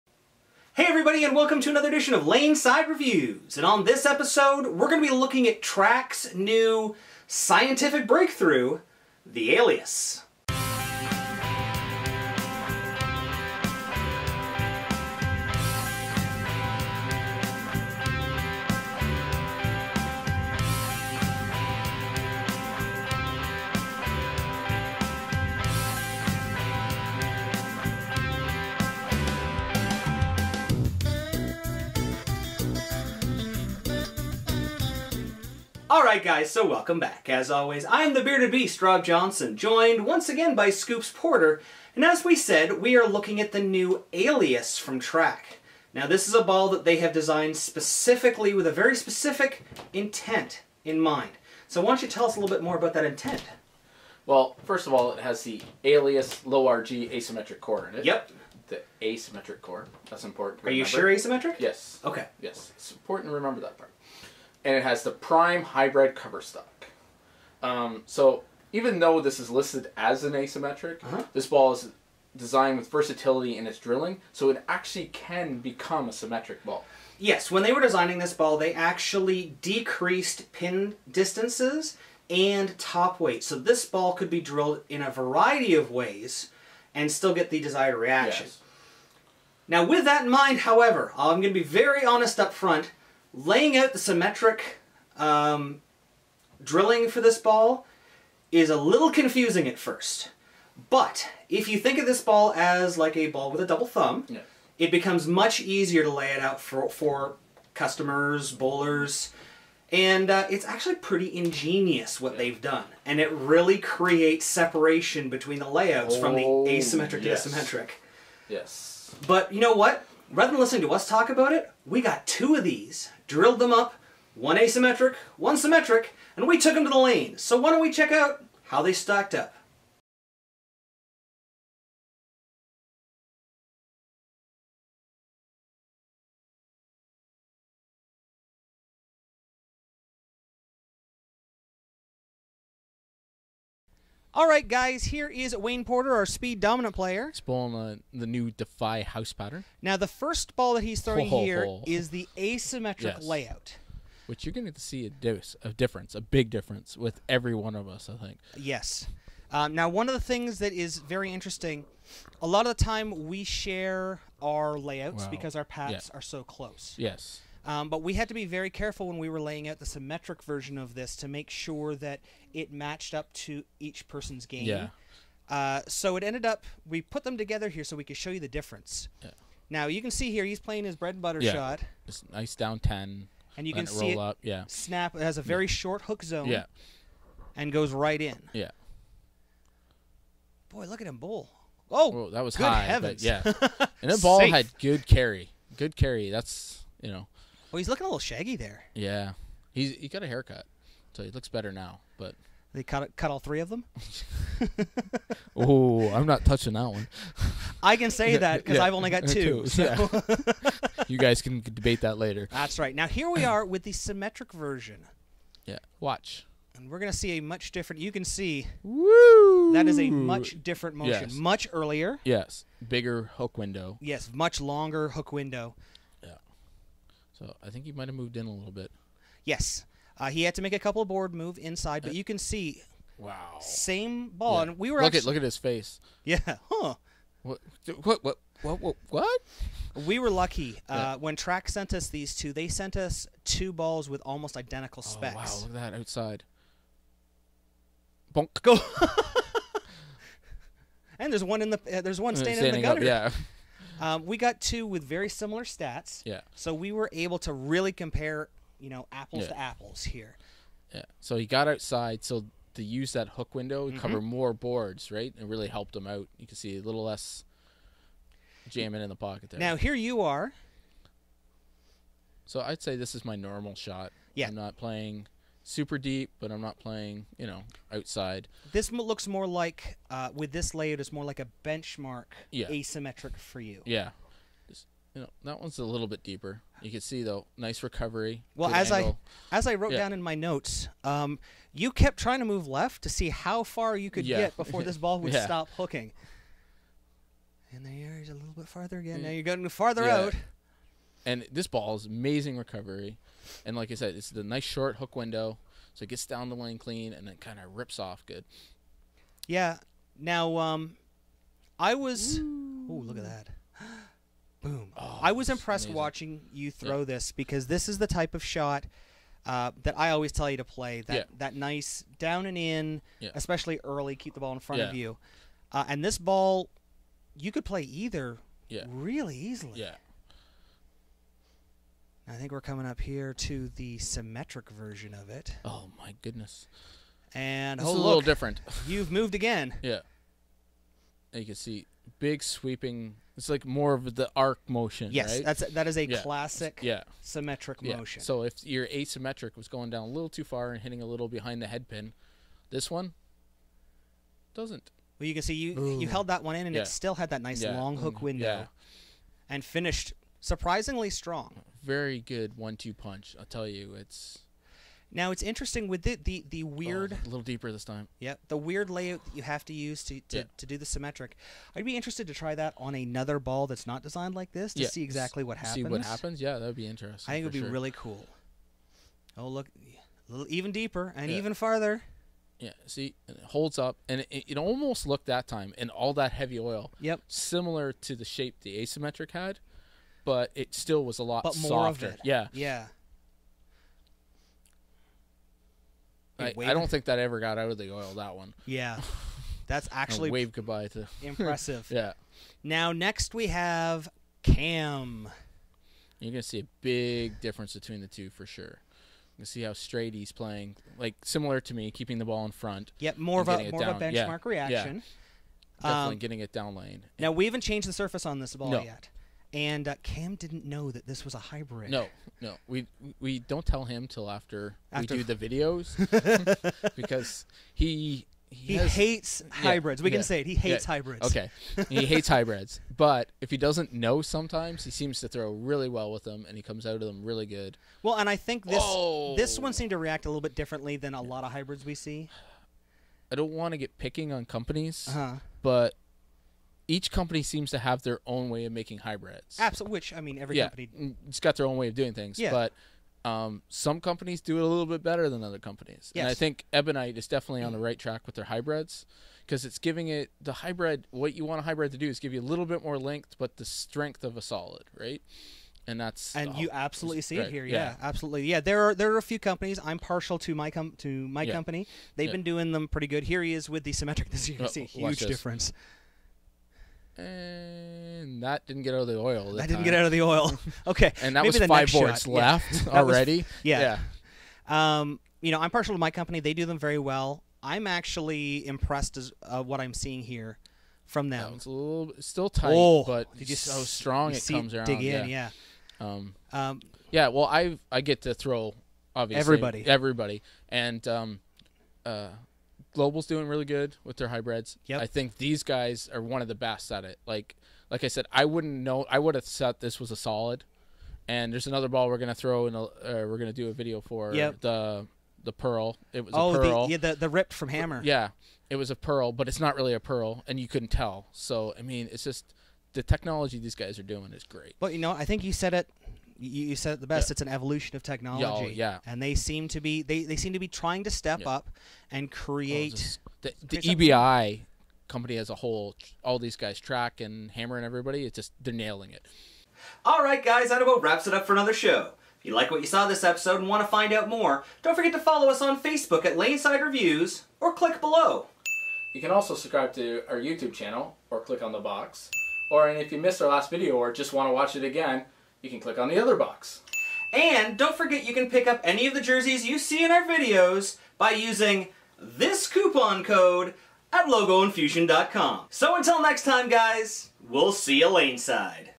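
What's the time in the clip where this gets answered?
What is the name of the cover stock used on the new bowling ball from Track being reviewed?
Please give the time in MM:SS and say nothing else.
01:05.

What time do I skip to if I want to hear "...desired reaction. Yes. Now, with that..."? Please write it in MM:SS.
01:27.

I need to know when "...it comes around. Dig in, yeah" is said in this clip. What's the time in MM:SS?
08:14.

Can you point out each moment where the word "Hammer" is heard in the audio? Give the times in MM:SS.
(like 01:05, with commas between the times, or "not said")
08:37, 08:57.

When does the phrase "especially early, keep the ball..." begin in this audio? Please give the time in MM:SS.
05:23.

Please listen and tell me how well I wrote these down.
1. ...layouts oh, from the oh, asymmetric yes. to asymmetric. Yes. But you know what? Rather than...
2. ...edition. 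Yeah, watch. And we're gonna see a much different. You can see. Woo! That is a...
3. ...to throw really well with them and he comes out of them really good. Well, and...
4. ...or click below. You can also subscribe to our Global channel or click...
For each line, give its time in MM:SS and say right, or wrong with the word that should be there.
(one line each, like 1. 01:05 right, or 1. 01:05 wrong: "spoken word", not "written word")
1. 01:55 right
2. 03:34 wrong: "version", not "edition"
3. 07:15 right
4. 09:07 wrong: "YouTube", not "Global".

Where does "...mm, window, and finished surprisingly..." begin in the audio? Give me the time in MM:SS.
05:58.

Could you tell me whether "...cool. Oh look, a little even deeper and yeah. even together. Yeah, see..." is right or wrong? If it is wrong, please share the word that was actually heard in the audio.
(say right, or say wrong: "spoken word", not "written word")
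wrong: "farther", not "together".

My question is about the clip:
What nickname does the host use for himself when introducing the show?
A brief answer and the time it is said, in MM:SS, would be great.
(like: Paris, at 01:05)
The Bearded Beast, at 00:38.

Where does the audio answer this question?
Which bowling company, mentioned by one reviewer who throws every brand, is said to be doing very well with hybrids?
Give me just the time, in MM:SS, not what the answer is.
08:22.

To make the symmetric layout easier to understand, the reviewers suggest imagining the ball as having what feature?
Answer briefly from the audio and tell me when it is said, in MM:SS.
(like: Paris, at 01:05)
A double thumb, at 01:43.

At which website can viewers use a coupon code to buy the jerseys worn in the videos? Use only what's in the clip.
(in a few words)
logoinfusion.com.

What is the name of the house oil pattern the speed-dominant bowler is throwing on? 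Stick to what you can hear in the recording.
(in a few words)
Defy.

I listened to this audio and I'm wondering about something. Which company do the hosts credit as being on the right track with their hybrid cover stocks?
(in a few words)
Ebonite.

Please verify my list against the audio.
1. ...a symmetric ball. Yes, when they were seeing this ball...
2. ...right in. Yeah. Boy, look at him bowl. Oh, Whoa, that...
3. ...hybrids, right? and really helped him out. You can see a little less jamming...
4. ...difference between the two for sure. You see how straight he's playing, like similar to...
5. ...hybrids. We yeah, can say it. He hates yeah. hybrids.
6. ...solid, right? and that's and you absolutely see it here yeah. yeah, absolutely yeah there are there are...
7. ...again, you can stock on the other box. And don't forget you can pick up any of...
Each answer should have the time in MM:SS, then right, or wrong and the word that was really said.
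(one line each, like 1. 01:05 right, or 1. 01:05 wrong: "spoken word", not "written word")
1. 01:16 wrong: "designing", not "seeing"
2. 03:07 right
3. 04:24 wrong: "boards", not "hybrids"
4. 06:47 right
5. 07:09 right
6. 07:44 right
7. 09:14 wrong: "click", not "stock".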